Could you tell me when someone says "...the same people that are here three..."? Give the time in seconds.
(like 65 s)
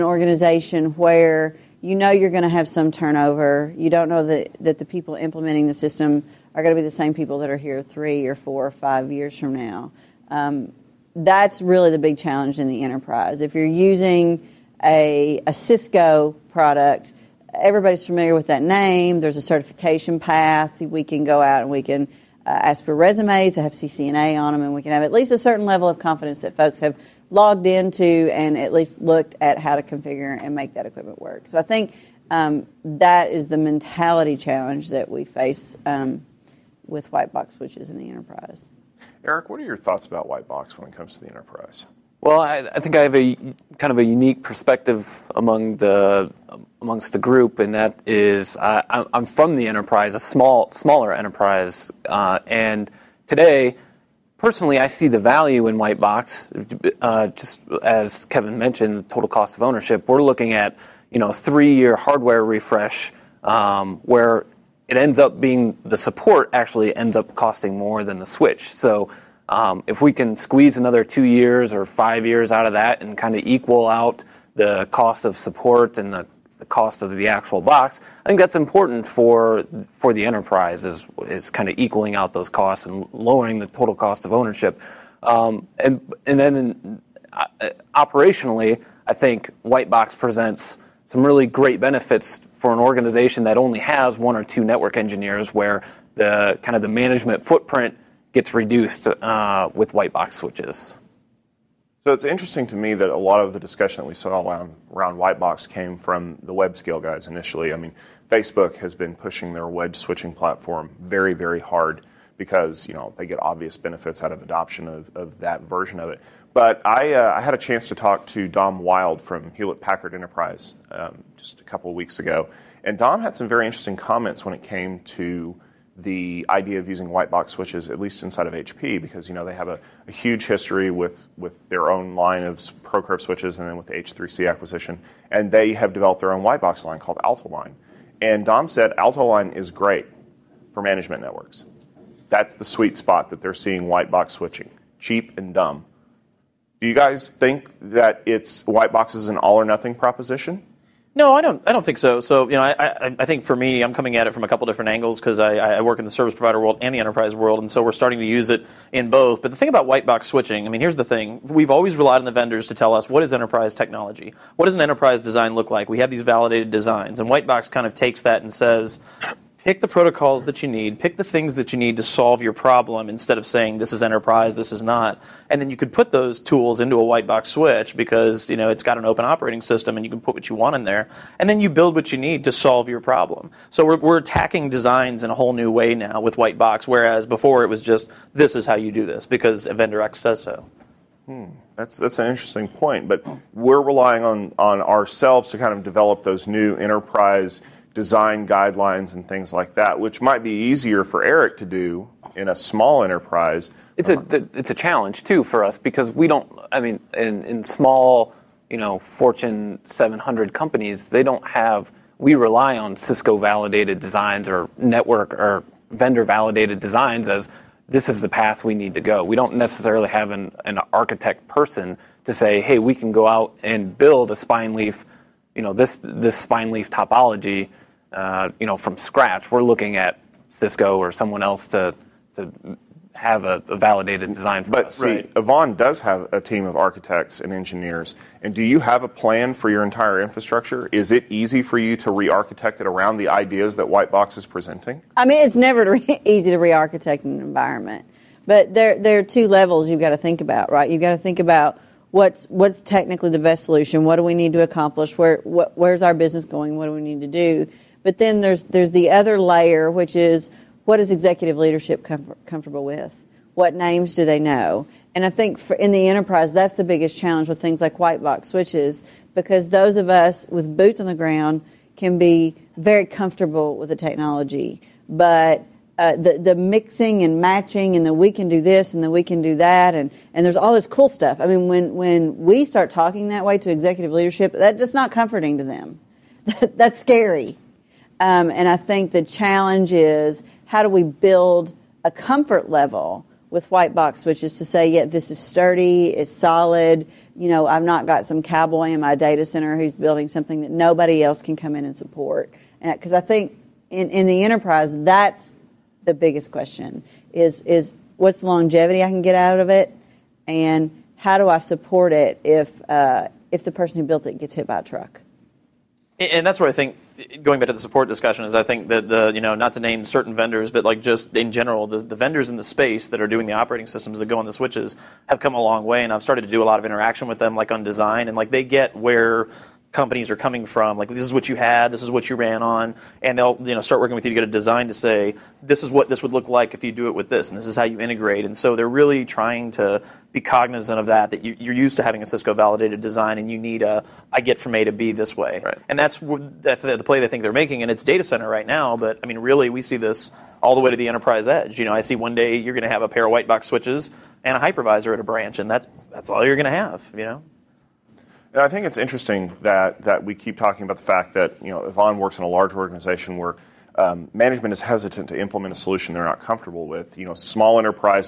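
6 s.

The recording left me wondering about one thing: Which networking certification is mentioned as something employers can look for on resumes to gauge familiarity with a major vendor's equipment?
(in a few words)
CCNA.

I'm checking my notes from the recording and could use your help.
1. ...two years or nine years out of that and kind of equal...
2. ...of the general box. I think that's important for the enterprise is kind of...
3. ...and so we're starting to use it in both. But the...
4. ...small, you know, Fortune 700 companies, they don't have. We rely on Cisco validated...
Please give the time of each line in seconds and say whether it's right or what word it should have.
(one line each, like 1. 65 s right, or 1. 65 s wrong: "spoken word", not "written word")
1. 71 s wrong: "five", not "nine"
2. 77 s wrong: "actual", not "general"
3. 157 s right
4. 207 s right.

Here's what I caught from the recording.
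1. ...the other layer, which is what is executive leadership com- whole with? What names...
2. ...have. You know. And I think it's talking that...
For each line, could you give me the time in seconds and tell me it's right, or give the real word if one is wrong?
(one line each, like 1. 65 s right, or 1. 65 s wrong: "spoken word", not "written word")
1. 258 s wrong: "comfortable", not "whole"
2. 356 s wrong: "interesting", not "talking".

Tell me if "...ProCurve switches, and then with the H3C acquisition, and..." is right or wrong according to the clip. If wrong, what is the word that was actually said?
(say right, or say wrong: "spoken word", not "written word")
right.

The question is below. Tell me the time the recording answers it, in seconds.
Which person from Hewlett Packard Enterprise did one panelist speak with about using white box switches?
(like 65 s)
118 s.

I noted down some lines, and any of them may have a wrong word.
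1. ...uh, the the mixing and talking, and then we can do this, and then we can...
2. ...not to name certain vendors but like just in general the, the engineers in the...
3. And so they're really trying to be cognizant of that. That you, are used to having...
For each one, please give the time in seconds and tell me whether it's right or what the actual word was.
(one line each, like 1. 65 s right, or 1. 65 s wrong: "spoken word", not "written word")
1. 275 s wrong: "matching", not "talking"
2. 319 s wrong: "vendors", not "engineers"
3. 338 s right.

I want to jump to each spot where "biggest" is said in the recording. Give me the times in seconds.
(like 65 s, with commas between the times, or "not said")
266 s, 306 s.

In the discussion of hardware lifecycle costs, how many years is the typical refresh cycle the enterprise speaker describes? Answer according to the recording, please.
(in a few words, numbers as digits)
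3 years.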